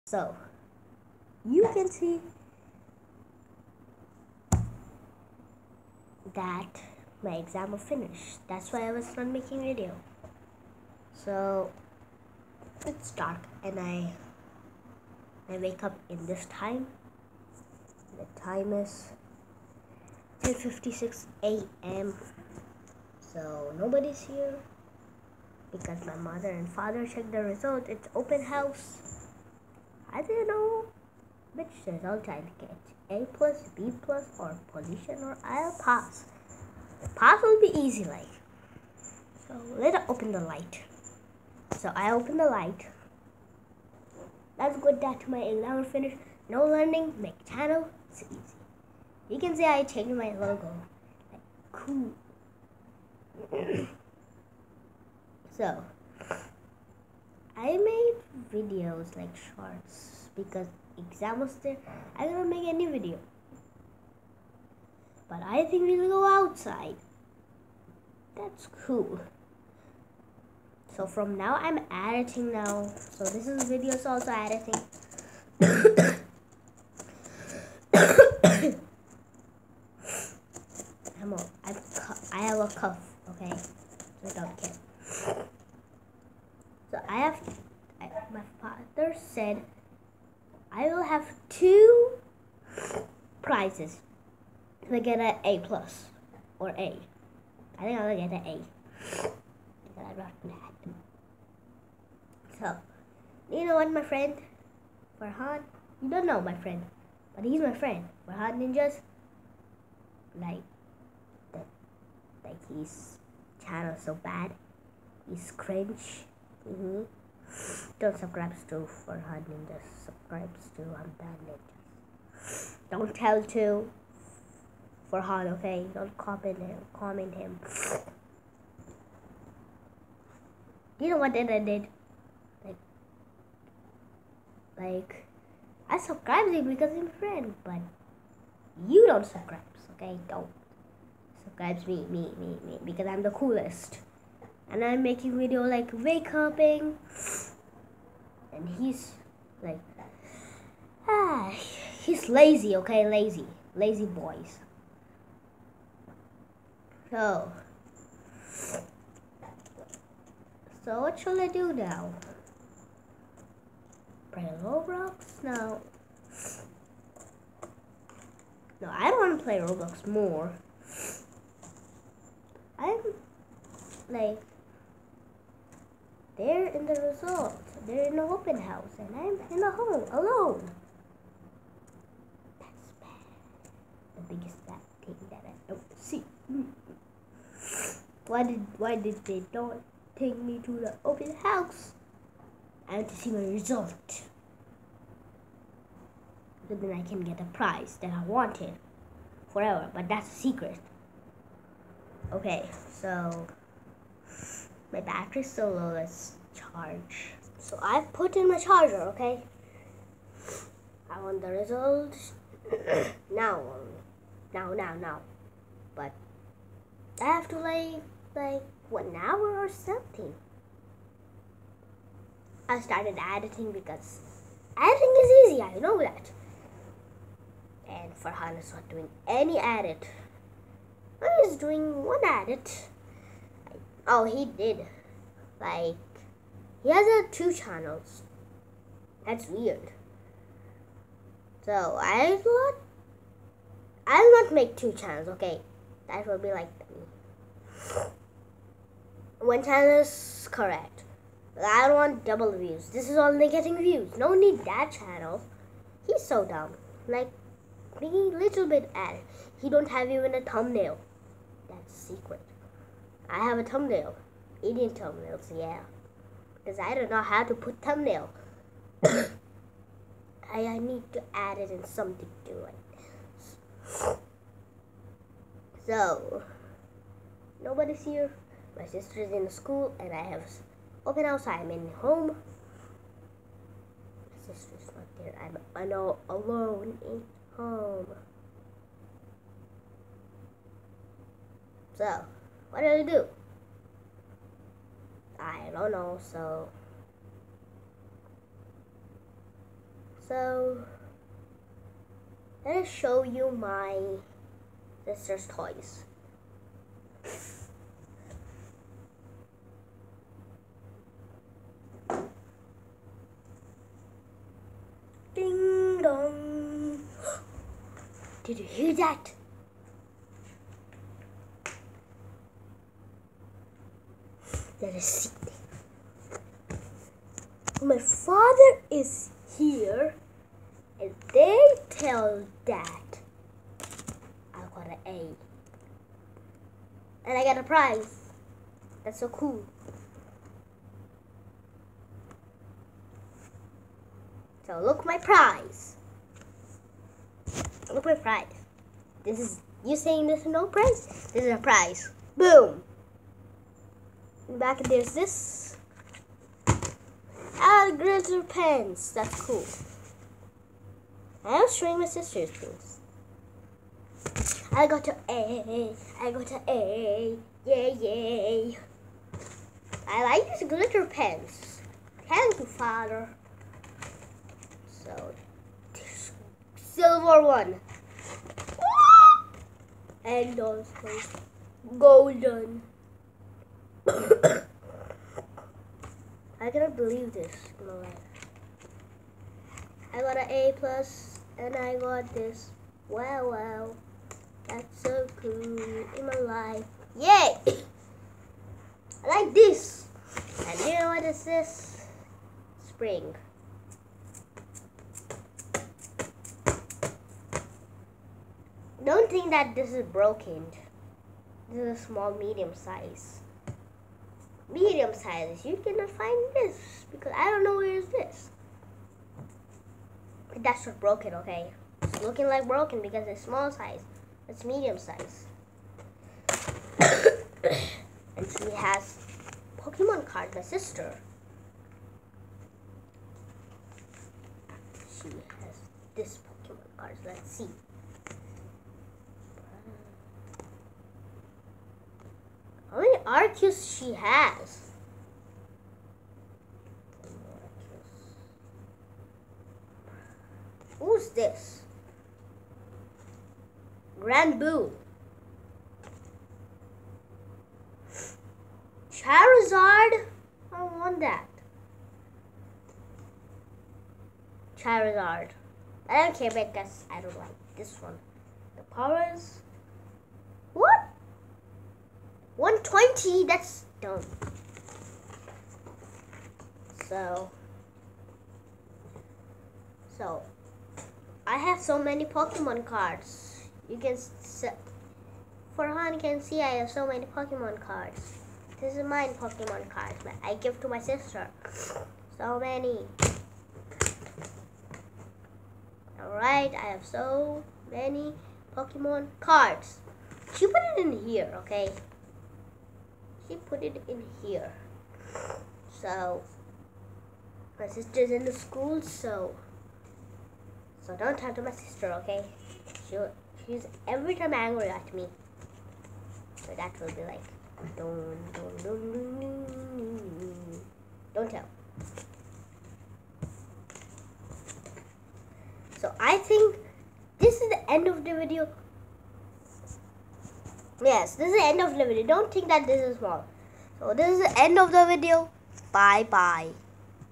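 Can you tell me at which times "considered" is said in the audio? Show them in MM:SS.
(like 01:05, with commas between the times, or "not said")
not said.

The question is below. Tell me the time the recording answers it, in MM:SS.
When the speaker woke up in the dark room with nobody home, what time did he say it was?
00:20.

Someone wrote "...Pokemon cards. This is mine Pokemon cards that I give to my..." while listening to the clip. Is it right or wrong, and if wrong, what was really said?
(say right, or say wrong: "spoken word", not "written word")
right.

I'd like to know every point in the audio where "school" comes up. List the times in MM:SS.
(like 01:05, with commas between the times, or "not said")
04:39, 08:28.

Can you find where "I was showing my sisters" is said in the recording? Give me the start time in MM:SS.
06:01.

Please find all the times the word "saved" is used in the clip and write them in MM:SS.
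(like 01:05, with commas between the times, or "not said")
not said.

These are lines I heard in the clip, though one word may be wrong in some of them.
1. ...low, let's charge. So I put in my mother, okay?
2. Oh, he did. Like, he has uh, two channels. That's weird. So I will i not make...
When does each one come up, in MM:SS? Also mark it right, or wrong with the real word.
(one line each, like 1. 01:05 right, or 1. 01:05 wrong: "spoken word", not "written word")
1. 03:25 wrong: "charger", not "mother"
2. 03:54 right.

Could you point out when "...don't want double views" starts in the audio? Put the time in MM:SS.
04:11.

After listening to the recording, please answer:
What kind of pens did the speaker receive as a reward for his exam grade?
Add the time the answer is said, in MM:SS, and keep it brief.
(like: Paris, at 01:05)
glitter pens, at 06:10.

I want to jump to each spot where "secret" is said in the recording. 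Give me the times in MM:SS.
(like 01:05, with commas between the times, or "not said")
03:20, 04:21.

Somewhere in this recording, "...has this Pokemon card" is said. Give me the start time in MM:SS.
07:15.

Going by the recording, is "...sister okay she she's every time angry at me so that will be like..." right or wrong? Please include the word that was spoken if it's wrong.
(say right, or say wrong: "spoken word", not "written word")
right.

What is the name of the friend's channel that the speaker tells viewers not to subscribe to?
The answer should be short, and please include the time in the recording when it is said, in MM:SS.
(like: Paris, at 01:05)
Farhan Ninjas, at 01:48.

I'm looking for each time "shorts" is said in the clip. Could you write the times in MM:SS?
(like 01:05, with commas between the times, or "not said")
00:59.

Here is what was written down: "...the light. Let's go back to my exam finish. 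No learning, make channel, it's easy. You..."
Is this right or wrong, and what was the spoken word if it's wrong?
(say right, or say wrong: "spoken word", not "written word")
right.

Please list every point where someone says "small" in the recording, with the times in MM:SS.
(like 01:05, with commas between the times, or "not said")
06:52, 07:03.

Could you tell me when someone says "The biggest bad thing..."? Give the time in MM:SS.
03:04.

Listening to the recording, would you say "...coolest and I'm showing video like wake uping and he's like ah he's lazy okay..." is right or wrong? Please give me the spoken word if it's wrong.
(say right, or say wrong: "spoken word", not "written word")
wrong: "making", not "showing".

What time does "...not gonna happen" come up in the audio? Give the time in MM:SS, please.
01:40.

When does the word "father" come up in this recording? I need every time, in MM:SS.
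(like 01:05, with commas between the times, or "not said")
00:26, 05:27, 06:12.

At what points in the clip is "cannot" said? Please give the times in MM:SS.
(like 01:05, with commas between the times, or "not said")
06:26, 06:55.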